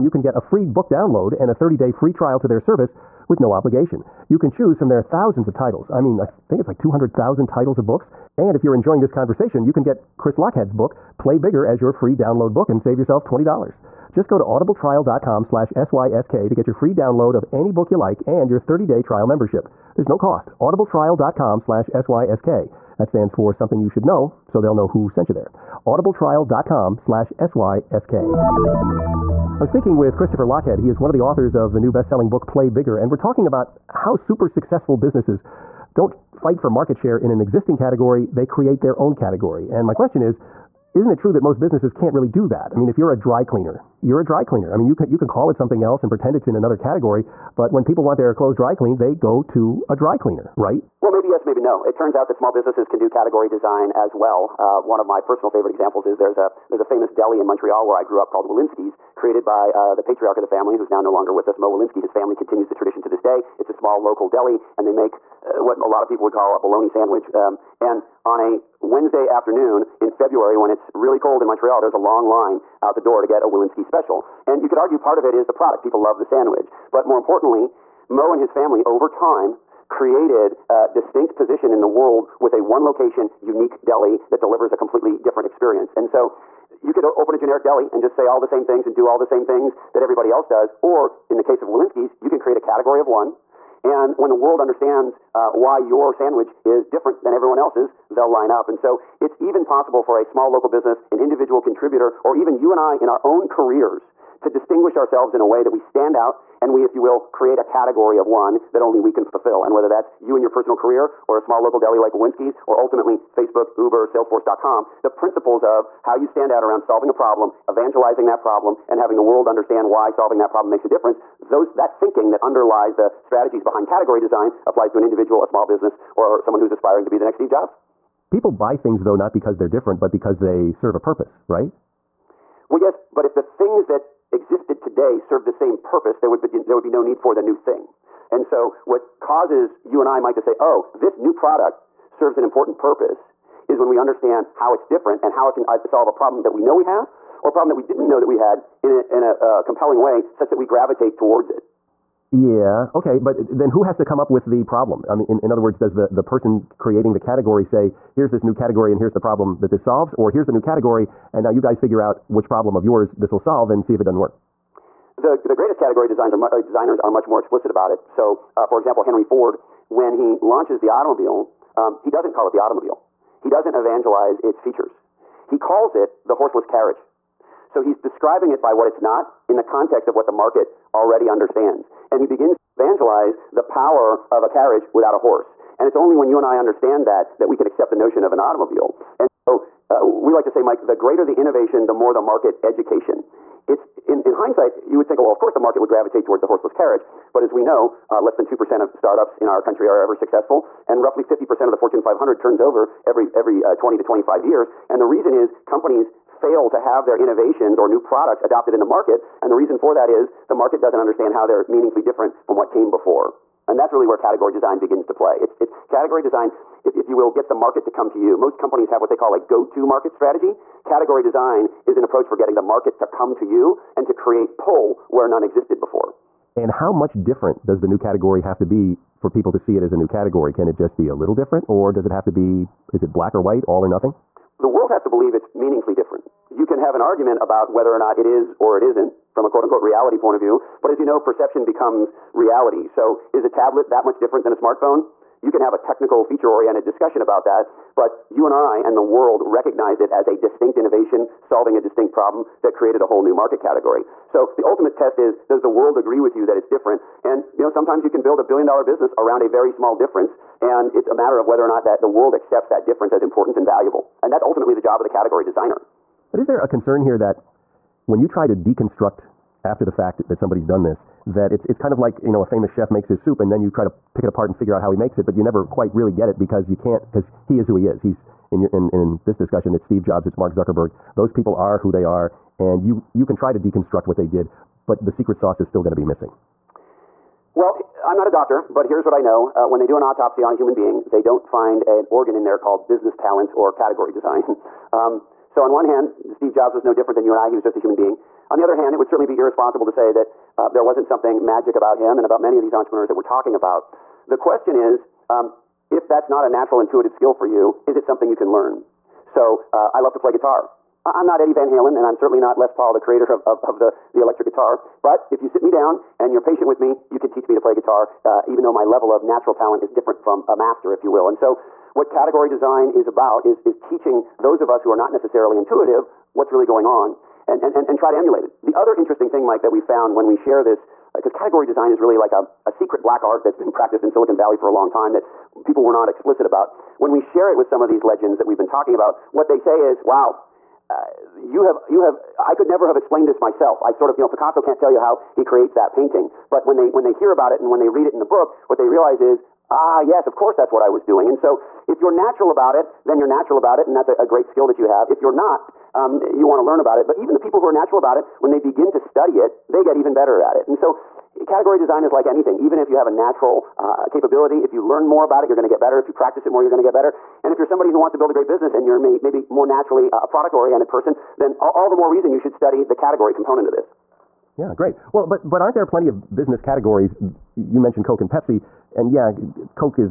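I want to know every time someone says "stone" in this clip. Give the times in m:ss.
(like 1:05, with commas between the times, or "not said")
not said.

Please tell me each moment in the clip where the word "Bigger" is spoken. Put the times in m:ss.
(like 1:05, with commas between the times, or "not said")
0:11, 0:32.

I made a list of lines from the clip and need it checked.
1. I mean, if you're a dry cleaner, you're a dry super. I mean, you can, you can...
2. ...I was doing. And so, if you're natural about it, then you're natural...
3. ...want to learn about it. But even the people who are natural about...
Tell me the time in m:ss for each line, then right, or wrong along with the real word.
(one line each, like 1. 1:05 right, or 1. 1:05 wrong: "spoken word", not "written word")
1. 0:42 wrong: "cleaner", not "super"
2. 5:50 right
3. 5:56 right.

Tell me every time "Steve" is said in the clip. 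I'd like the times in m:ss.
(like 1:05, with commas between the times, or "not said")
2:07, 4:39, 4:56.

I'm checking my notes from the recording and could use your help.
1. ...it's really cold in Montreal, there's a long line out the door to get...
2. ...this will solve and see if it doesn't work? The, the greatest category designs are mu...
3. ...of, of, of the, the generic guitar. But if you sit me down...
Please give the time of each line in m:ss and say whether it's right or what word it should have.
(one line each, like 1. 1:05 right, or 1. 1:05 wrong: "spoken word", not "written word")
1. 1:10 right
2. 2:43 right
3. 5:13 wrong: "electric", not "generic".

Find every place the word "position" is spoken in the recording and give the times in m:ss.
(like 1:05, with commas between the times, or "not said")
1:21.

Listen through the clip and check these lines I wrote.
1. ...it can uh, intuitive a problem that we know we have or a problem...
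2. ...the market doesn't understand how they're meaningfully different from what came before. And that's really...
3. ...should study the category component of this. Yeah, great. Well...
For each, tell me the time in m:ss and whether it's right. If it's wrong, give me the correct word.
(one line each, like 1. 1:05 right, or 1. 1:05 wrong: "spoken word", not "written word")
1. 2:25 wrong: "solve", not "intuitive"
2. 3:30 right
3. 6:12 right.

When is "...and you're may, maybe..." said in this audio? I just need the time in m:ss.
6:08.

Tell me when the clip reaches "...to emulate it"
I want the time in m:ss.
5:28.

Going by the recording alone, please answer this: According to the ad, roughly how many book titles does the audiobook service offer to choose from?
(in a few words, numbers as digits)
200,000.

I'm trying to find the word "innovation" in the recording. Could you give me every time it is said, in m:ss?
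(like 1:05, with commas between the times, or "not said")
3:11, 3:27, 4:10.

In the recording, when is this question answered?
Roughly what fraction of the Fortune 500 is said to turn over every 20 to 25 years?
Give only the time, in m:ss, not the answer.
3:21.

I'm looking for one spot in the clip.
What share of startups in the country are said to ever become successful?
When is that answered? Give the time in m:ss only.
3:18.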